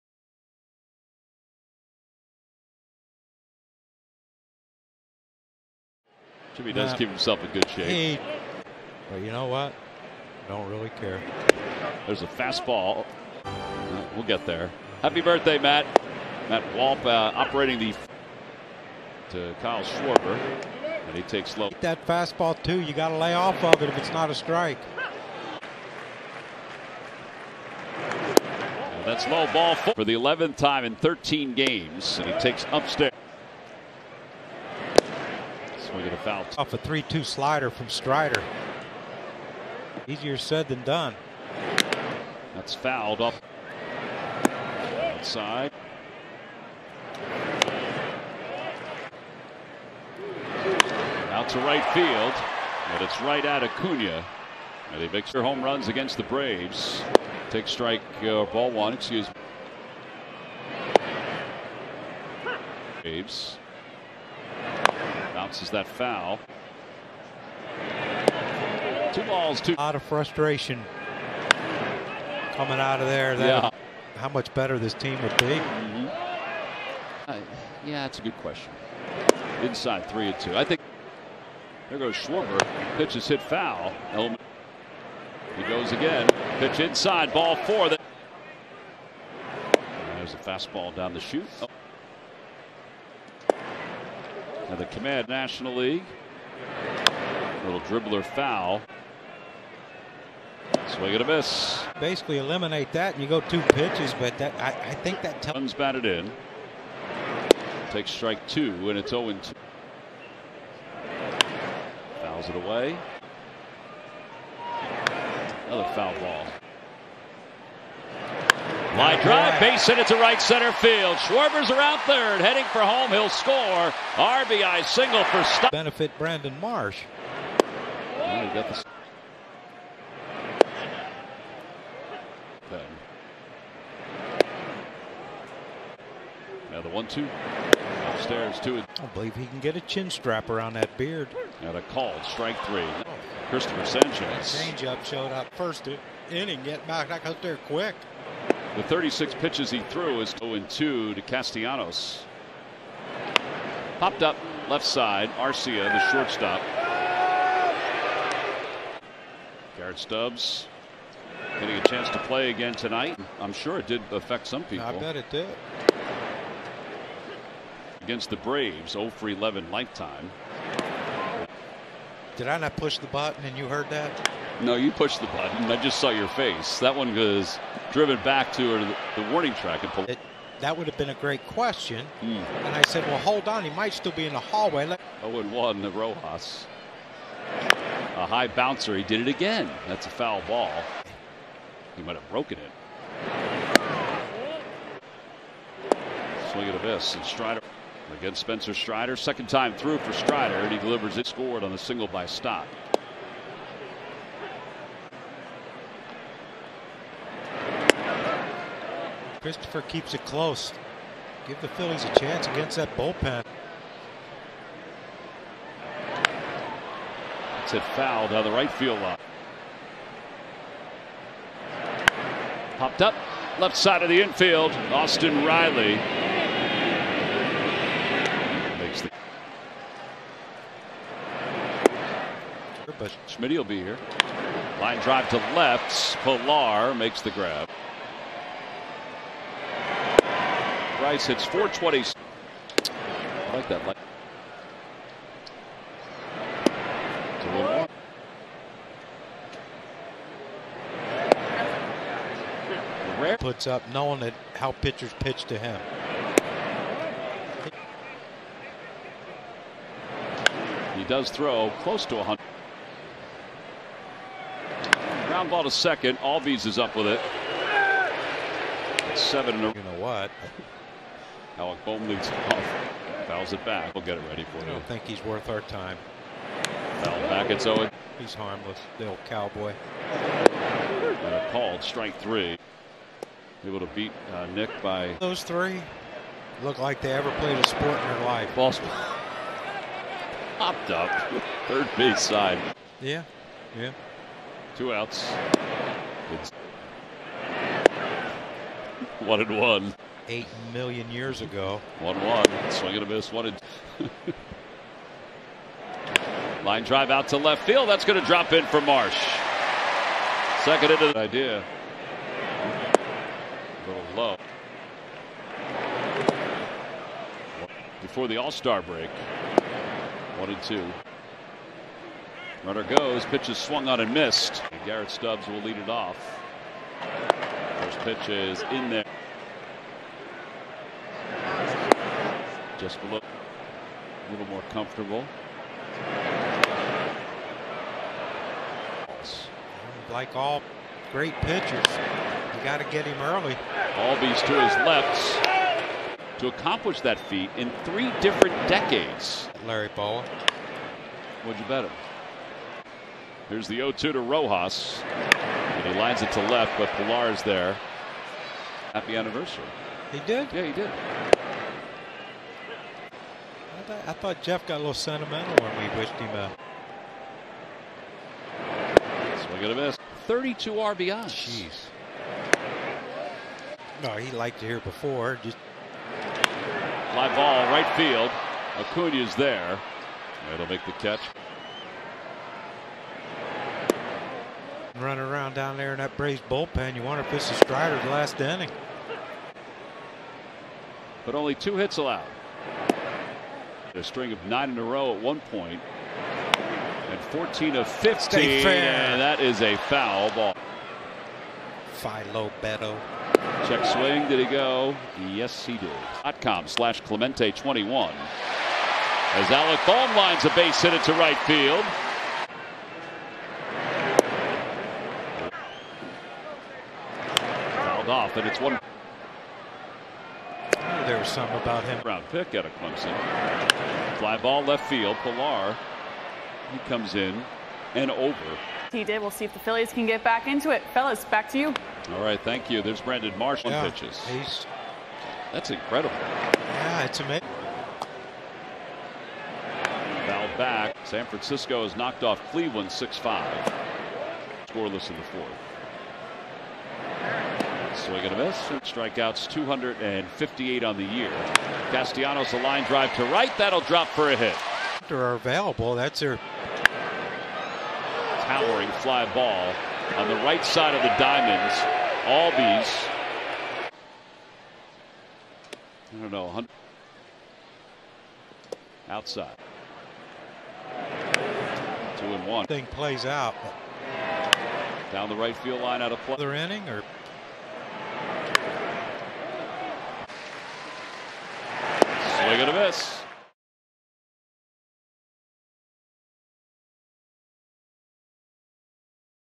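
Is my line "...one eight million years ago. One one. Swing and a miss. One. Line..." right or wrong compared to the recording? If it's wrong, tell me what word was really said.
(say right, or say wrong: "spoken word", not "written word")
right.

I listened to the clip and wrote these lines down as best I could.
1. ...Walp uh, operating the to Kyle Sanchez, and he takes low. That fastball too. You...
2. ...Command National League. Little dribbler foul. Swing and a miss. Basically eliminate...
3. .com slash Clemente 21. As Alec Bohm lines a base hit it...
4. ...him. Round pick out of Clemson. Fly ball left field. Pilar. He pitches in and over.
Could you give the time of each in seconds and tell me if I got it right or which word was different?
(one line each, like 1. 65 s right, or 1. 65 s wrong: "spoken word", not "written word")
1. 16 s wrong: "Schwarber", not "Sanchez"
2. 94 s right
3. 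406 s right
4. 421 s wrong: "comes", not "pitches".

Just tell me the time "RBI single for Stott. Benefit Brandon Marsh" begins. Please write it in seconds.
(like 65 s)
124 s.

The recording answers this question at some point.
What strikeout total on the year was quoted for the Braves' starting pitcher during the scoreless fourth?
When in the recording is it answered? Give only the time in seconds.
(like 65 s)
449 s.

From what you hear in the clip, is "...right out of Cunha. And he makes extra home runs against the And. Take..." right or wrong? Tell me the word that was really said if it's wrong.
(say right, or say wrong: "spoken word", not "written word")
wrong: "Braves", not "And".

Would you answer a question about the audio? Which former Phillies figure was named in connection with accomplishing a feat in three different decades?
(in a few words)
Larry Bowa.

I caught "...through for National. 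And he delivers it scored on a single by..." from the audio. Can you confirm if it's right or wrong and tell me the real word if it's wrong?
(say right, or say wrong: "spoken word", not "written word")
wrong: "Strider", not "National".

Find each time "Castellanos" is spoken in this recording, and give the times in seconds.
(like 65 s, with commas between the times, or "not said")
151 s, 451 s.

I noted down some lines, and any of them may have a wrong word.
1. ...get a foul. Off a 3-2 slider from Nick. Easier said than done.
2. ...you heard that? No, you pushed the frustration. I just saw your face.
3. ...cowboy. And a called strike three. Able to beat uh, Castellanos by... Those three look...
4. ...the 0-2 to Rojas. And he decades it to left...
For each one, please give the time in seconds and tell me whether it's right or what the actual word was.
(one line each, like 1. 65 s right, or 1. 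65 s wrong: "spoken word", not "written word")
1. 36 s wrong: "Strider", not "Nick"
2. 173 s wrong: "button", not "frustration"
3. 279 s wrong: "Nick", not "Castellanos"
4. 353 s wrong: "lines", not "decades".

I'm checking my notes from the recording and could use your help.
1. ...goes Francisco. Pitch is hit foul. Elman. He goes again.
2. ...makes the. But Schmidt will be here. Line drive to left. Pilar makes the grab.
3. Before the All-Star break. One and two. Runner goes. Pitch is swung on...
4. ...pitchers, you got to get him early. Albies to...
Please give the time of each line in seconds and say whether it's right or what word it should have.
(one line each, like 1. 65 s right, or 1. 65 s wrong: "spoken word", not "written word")
1. 81 s wrong: "Schwarber", not "Francisco"
2. 228 s right
3. 318 s right
4. 341 s right.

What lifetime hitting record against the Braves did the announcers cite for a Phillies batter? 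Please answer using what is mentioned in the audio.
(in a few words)
0 for 11.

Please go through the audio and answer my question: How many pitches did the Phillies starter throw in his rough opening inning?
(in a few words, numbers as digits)
36.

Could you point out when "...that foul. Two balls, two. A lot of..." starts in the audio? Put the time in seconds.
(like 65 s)
65 s.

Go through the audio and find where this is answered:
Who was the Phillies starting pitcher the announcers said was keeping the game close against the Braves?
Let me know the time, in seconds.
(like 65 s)
143 s.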